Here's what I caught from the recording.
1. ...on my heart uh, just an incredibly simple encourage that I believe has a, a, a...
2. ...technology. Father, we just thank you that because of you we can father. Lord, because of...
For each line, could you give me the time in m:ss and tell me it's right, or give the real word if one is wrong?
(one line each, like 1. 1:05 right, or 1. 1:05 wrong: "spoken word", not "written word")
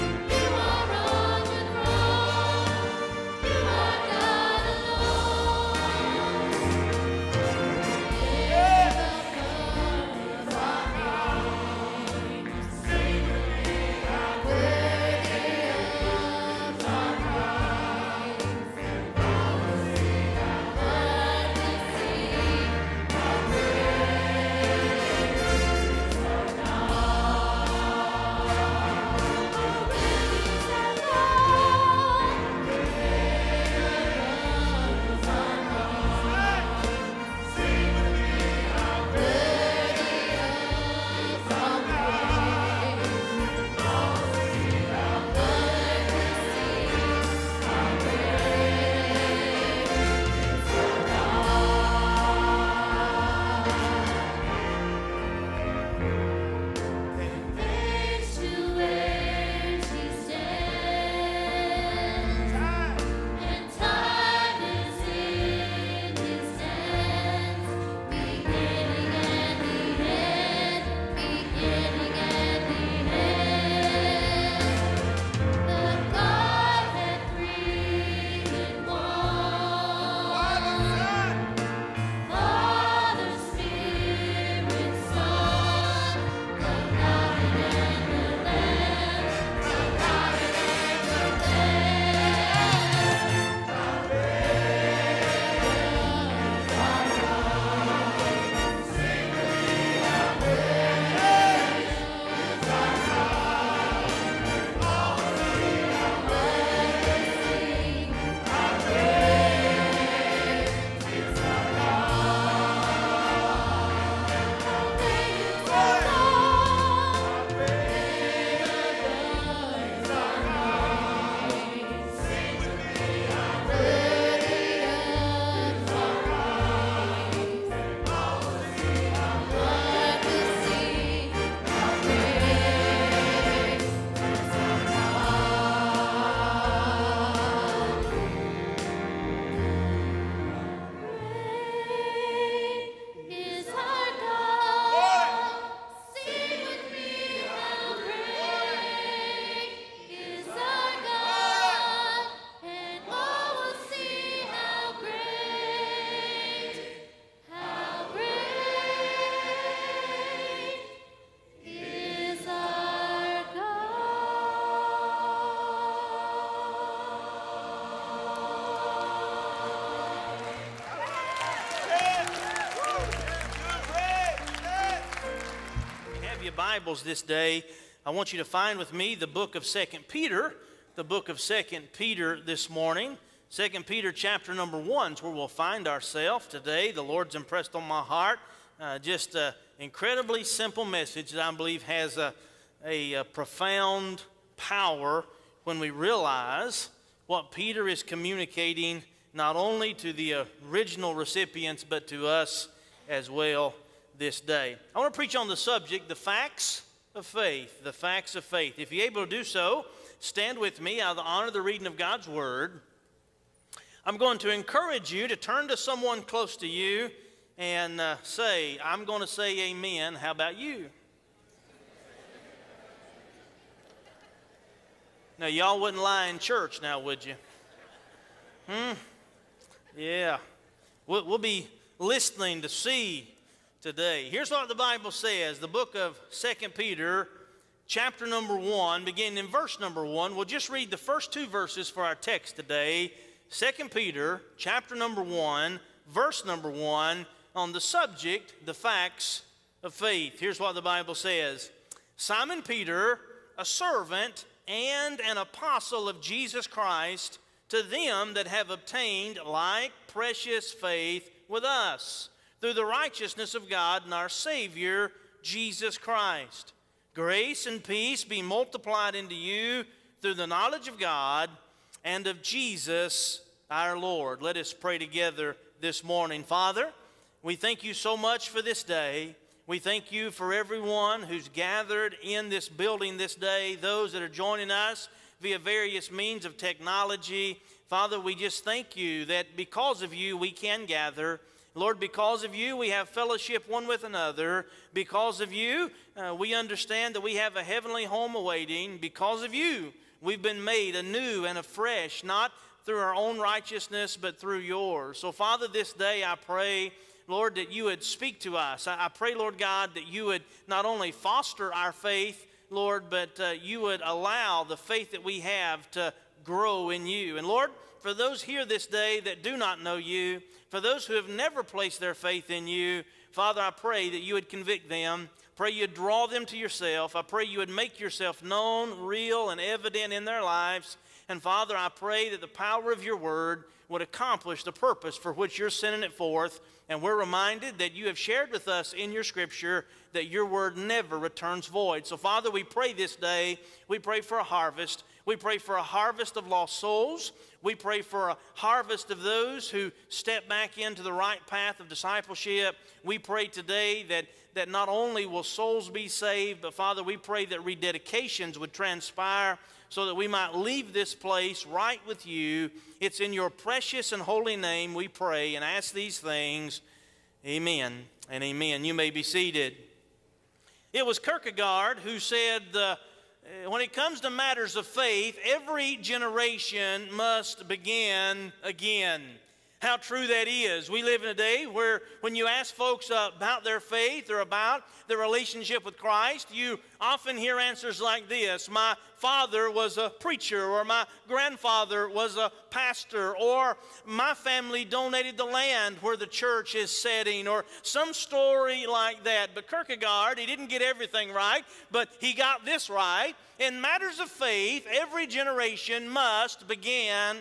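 1. 3:07 wrong: "message", not "encourage"
2. 4:46 wrong: "gather", not "father".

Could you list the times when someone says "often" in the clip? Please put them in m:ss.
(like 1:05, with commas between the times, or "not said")
6:27.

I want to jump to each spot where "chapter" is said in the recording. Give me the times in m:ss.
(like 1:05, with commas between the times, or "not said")
3:04, 3:57, 4:04.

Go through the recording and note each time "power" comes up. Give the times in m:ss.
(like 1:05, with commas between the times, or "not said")
3:14, 5:32.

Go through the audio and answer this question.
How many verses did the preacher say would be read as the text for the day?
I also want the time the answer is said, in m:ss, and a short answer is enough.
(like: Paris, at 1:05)
2, at 4:01.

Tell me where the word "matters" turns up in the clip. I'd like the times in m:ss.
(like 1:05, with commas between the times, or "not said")
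6:14, 6:43.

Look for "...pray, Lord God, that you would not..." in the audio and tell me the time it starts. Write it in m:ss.
5:09.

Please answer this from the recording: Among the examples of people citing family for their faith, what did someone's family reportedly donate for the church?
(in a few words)
The land.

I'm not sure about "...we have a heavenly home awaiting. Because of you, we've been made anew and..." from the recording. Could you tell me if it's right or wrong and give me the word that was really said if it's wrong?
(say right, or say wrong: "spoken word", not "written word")
right.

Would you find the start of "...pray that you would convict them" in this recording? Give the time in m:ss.
5:23.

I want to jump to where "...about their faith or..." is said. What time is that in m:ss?
6:23.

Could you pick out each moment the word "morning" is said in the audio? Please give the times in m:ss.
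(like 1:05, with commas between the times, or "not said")
3:02, 4:36.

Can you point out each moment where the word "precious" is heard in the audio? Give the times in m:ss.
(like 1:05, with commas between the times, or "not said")
4:20, 6:03.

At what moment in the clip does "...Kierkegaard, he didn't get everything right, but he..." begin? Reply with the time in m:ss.
6:39.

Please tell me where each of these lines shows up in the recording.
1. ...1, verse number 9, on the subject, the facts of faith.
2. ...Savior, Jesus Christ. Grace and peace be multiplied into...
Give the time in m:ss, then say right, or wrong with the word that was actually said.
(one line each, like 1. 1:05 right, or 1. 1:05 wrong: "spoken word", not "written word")
1. 4:05 wrong: "1", not "9"
2. 4:24 right.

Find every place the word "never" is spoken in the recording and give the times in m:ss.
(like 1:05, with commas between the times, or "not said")
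5:21, 5:40.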